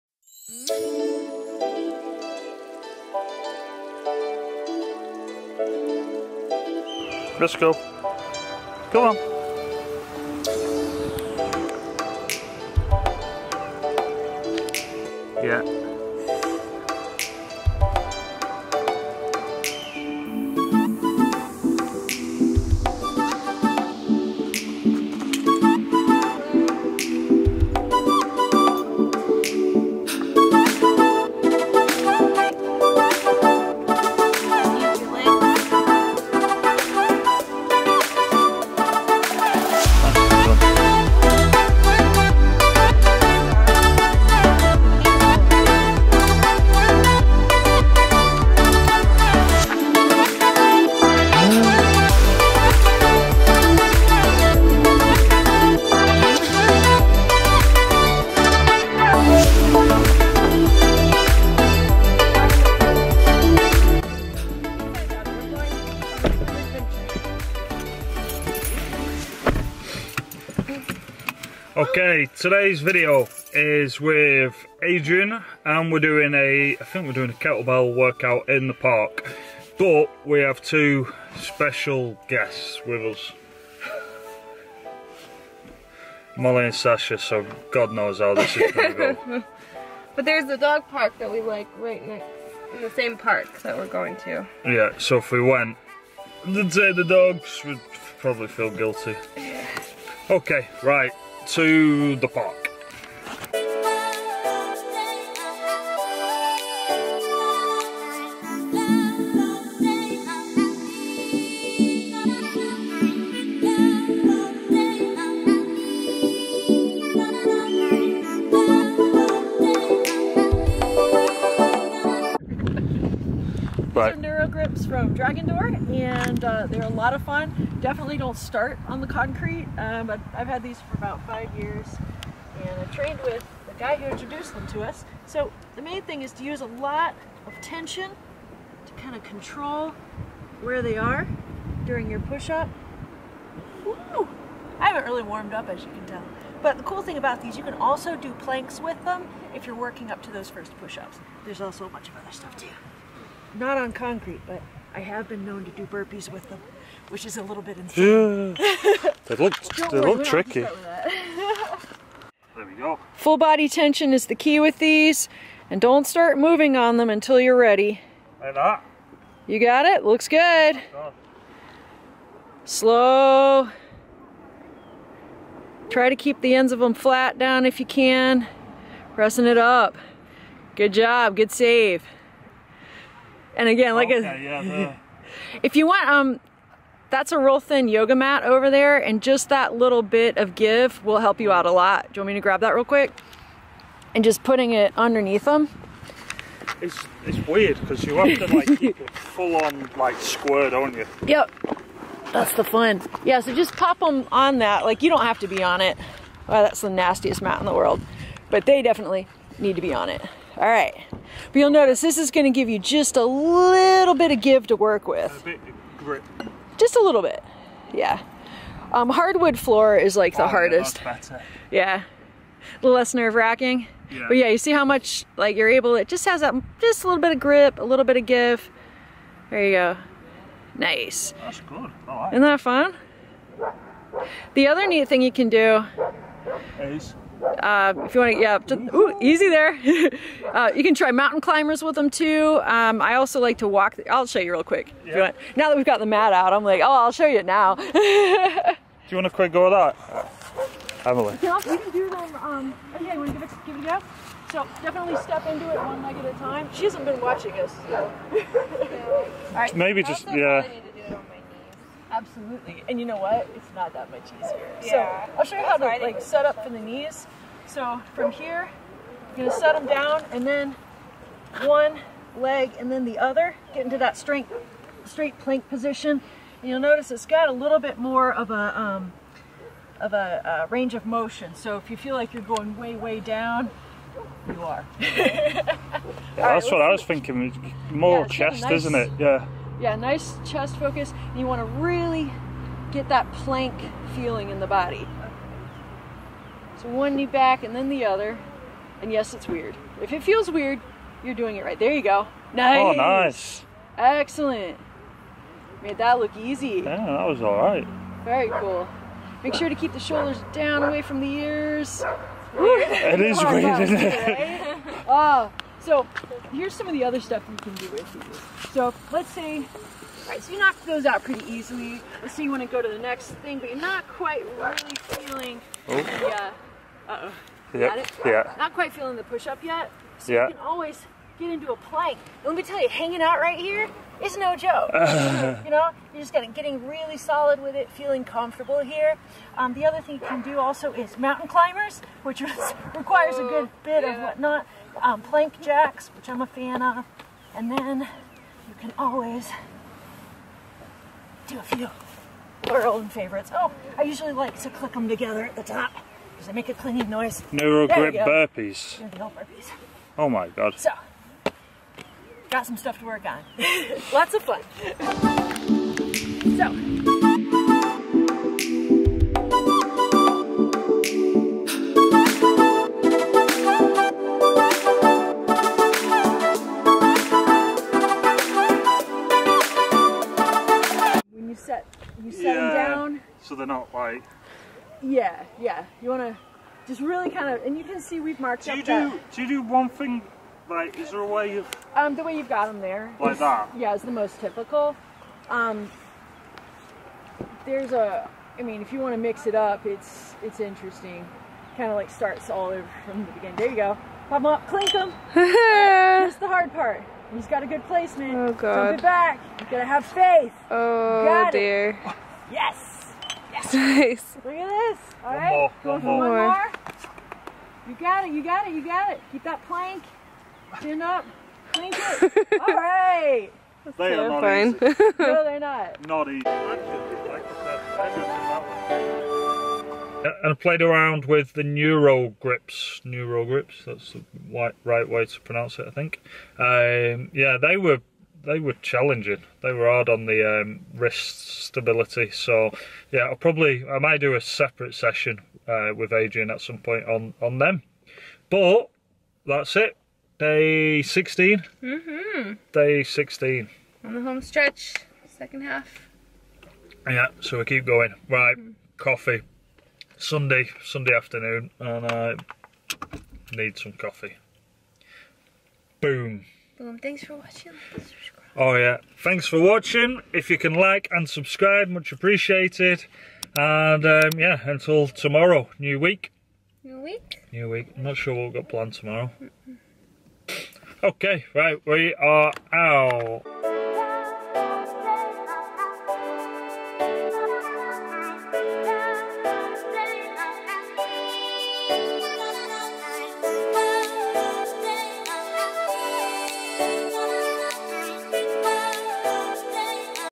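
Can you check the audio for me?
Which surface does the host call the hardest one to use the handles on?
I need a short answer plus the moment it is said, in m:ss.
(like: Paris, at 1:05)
hardwood floor, at 3:39.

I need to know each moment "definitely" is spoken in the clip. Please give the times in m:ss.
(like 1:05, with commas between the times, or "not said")
2:07, 3:28, 4:14.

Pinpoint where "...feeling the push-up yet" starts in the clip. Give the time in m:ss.
5:28.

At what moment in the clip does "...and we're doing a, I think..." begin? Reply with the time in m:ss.
1:15.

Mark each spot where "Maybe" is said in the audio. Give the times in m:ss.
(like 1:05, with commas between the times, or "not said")
4:19.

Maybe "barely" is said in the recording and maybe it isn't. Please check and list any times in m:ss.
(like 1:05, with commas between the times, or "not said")
not said.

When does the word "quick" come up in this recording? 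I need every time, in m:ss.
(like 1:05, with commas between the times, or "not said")
3:12, 4:04, 4:09.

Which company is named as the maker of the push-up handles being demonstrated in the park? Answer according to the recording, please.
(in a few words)
Dragon Door.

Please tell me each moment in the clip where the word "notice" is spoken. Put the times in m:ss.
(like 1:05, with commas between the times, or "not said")
3:31, 4:36.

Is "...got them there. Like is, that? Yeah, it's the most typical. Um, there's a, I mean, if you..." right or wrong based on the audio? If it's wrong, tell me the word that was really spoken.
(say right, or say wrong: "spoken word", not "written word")
right.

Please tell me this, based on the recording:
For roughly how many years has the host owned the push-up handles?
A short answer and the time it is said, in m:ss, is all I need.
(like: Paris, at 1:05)
5, at 2:11.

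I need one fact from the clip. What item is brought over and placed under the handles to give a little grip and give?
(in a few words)
thin yoga mat.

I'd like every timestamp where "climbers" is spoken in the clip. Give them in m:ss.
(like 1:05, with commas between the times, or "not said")
4:01, 5:41.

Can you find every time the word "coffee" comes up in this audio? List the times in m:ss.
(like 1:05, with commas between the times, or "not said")
7:38, 7:43.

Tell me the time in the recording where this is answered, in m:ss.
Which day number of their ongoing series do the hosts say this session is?
7:32.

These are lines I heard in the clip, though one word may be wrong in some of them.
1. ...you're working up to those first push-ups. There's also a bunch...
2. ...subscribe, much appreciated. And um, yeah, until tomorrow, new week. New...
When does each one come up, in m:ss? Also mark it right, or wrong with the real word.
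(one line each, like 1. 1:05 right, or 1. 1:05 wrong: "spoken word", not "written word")
1. 2:29 right
2. 7:51 right.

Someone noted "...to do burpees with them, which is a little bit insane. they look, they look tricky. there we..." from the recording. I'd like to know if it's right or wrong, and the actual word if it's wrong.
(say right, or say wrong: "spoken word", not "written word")
right.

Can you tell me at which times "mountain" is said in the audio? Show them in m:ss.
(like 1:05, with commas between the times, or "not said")
4:01, 5:41.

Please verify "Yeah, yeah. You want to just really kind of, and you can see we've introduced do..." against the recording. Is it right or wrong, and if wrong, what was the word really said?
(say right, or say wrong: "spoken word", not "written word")
wrong: "marked", not "introduced".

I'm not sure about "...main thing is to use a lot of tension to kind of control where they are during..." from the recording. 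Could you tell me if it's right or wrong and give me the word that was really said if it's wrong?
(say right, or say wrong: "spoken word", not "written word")
right.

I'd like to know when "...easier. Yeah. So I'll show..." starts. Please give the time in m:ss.
4:24.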